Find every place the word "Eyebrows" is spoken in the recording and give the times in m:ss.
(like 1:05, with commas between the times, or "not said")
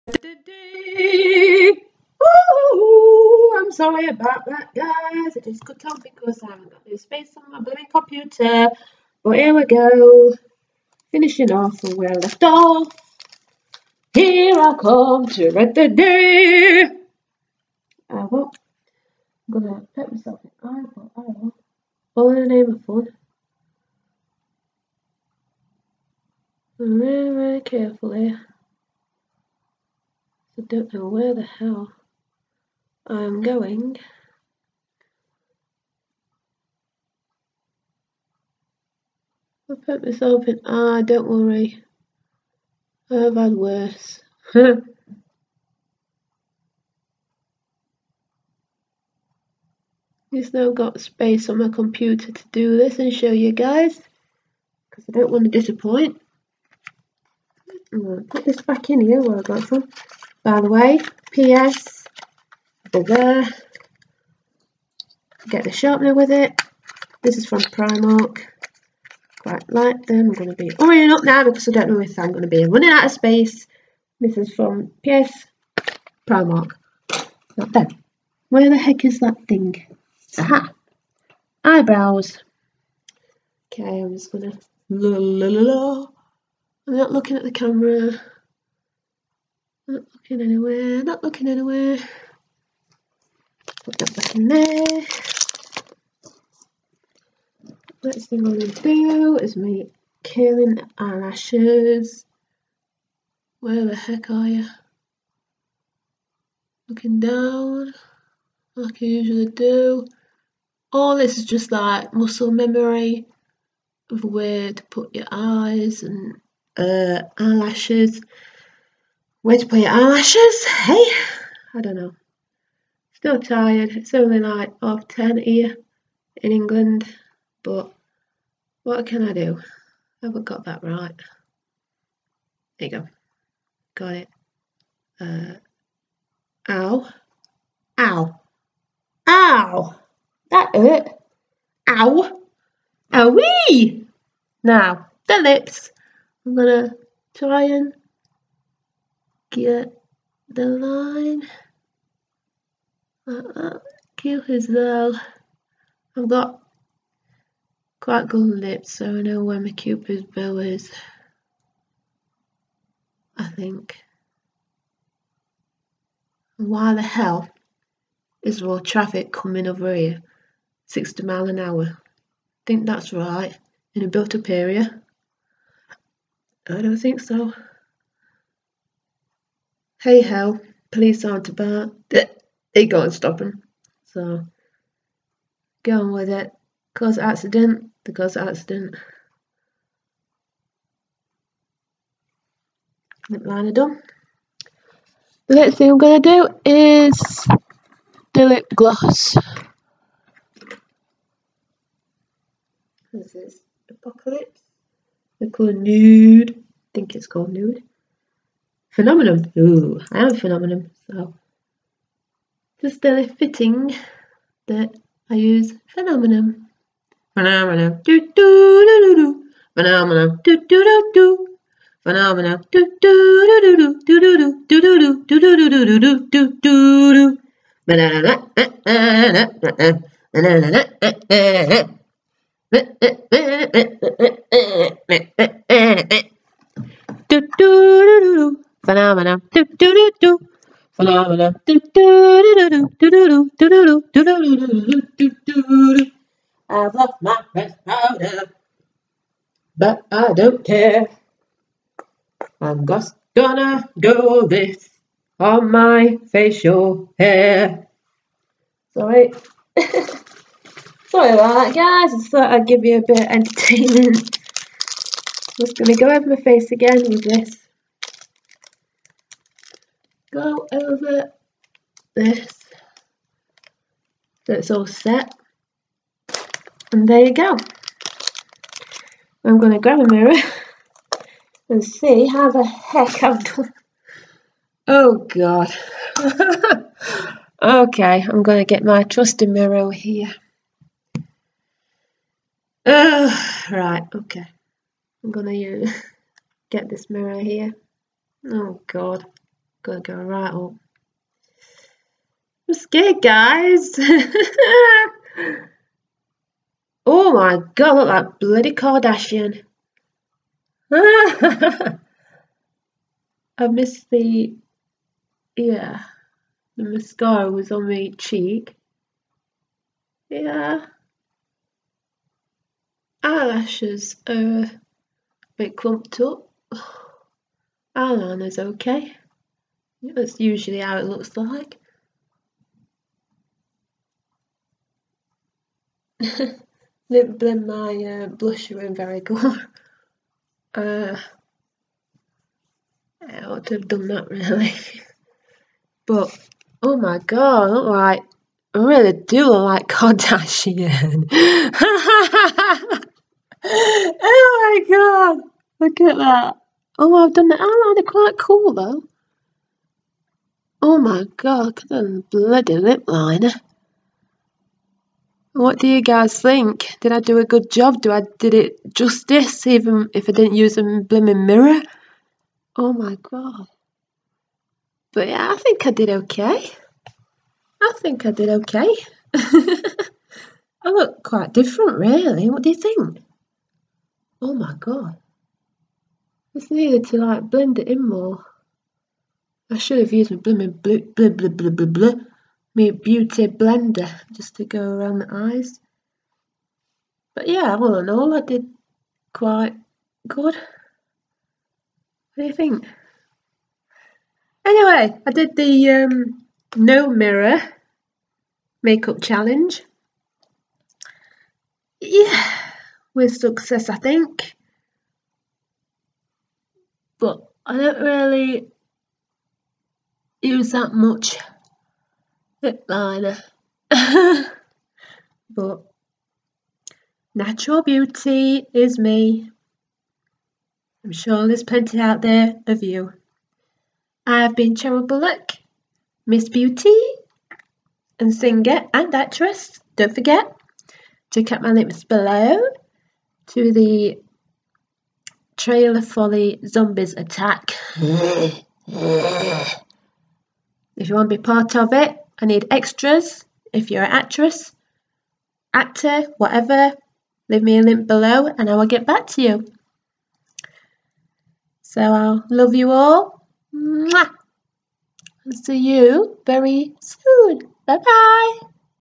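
1:21.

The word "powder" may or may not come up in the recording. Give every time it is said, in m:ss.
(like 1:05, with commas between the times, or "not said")
4:07.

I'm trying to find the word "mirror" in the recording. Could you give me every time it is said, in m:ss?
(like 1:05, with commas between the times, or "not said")
4:40, 4:49, 4:57, 6:11, 6:47.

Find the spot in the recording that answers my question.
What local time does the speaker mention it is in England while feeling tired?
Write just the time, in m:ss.
2:04.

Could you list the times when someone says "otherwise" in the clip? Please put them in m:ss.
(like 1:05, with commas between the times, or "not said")
not said.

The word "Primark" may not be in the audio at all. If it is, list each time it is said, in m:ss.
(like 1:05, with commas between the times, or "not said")
1:07, 1:16.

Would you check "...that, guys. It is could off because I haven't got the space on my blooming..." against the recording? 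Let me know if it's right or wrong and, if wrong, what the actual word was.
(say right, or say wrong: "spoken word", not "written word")
right.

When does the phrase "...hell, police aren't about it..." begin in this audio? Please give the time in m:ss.
3:00.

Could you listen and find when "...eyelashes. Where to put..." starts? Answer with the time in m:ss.
1:57.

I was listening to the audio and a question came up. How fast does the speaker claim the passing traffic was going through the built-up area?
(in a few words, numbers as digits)
60 miles an hour.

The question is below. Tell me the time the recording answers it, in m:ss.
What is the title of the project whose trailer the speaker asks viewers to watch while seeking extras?
7:26.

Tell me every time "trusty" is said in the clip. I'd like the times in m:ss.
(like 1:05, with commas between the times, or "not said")
4:49.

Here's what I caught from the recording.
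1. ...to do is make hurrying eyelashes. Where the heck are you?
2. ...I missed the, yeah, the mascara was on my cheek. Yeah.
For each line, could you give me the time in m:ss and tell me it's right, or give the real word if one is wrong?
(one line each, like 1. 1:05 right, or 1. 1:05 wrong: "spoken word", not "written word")
1. 1:38 wrong: "curling", not "hurrying"
2. 5:13 right.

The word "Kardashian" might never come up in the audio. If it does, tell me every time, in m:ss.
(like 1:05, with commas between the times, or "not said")
5:08, 5:49.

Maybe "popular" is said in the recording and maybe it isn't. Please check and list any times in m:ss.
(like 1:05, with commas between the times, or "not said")
not said.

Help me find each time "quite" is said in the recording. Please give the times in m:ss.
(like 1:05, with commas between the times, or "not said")
1:09, 2:37, 5:58, 6:21, 6:39.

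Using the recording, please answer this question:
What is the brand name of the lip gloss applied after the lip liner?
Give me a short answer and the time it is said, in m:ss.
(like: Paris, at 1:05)
Apocalips, at 3:23.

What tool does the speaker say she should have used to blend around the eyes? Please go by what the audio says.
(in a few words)
beauty blender.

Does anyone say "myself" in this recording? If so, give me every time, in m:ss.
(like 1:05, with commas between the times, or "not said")
0:20, 0:40.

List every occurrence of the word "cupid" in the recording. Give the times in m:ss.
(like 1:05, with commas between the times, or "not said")
2:39.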